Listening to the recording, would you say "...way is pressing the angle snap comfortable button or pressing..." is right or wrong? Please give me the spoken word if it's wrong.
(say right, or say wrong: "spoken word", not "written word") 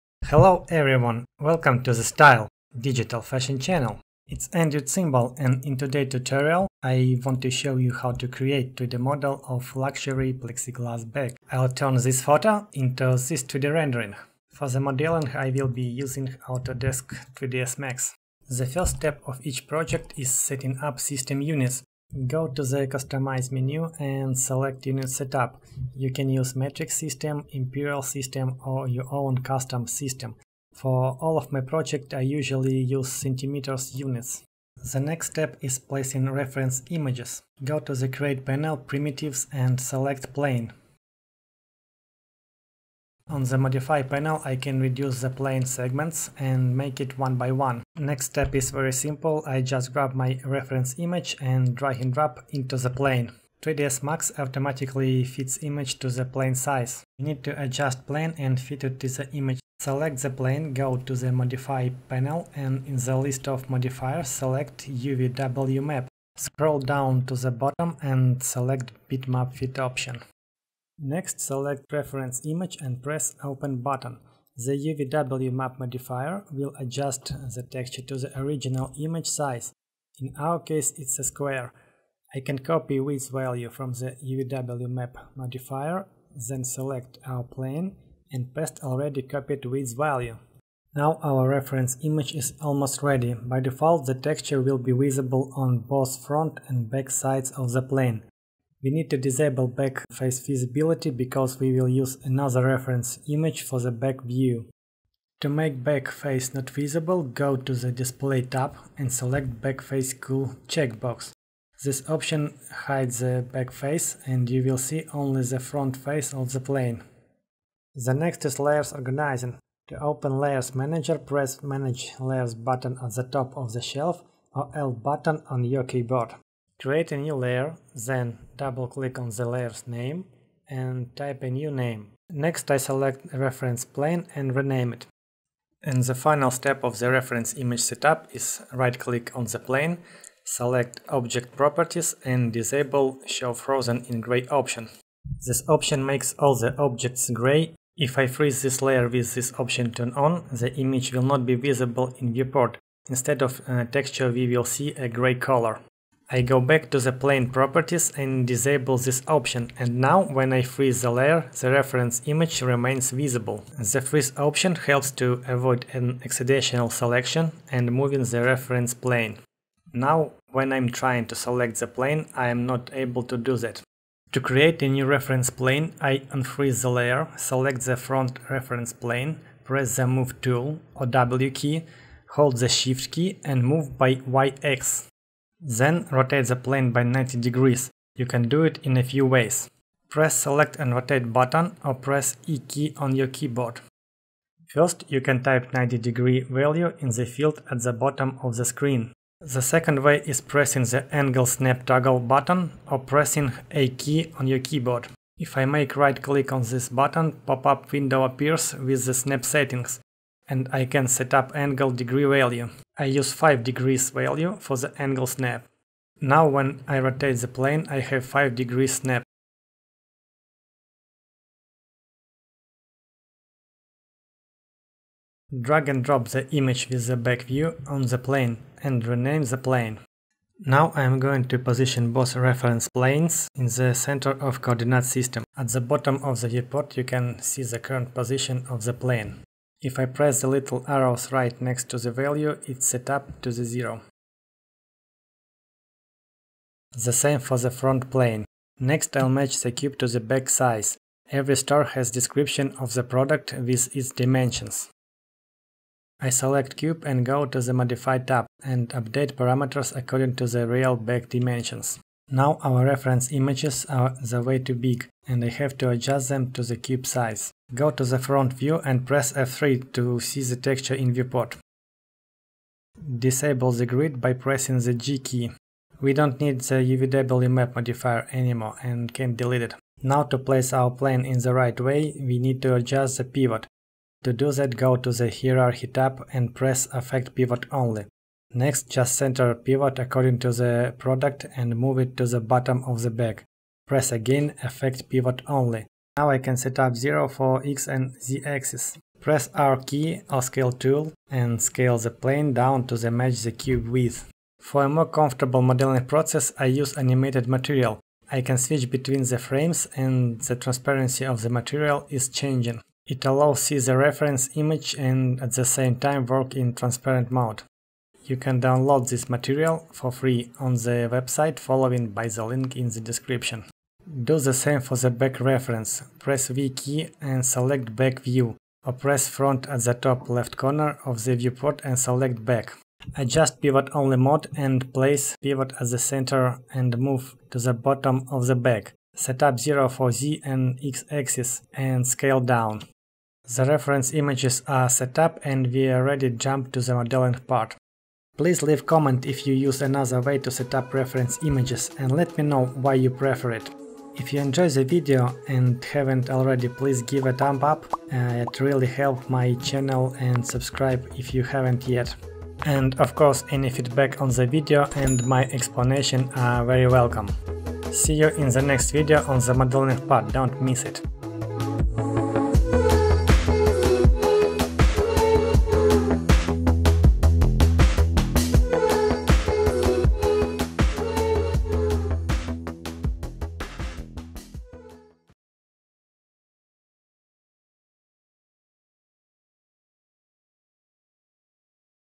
wrong: "toggle", not "comfortable".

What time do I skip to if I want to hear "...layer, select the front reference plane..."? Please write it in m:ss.
2:56.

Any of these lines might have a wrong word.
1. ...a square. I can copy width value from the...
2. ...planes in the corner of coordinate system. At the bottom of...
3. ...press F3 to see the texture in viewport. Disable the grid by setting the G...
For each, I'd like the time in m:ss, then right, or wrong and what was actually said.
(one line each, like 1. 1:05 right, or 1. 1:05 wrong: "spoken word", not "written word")
1. 1:21 right
2. 3:52 wrong: "center", not "corner"
3. 4:29 wrong: "pressing", not "setting".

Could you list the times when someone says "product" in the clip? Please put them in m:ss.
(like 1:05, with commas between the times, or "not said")
4:13, 4:50.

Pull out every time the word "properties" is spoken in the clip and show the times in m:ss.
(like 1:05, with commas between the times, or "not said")
2:21, 2:37.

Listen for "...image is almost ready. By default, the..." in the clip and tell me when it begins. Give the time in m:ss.
1:32.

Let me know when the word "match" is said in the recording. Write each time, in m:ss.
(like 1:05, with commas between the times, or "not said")
4:09, 5:03.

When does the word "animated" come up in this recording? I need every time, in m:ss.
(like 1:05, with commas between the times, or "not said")
5:06.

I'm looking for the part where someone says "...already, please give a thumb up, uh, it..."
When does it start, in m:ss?
5:56.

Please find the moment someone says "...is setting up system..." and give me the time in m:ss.
0:20.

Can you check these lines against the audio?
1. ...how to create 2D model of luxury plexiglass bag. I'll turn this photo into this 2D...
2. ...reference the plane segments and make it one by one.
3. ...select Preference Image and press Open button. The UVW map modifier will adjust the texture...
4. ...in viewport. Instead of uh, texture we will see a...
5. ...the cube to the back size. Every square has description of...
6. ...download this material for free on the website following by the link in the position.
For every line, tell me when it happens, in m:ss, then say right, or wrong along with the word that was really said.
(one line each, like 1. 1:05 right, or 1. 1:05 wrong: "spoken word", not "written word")
1. 0:07 right
2. 0:44 wrong: "reduce", not "reference"
3. 1:11 right
4. 2:32 right
5. 4:09 wrong: "store", not "square"
6. 5:18 wrong: "description", not "position".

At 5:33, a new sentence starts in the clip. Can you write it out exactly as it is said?
Adjust pivot only mode and place pivot at the center and move to the bottom of the back.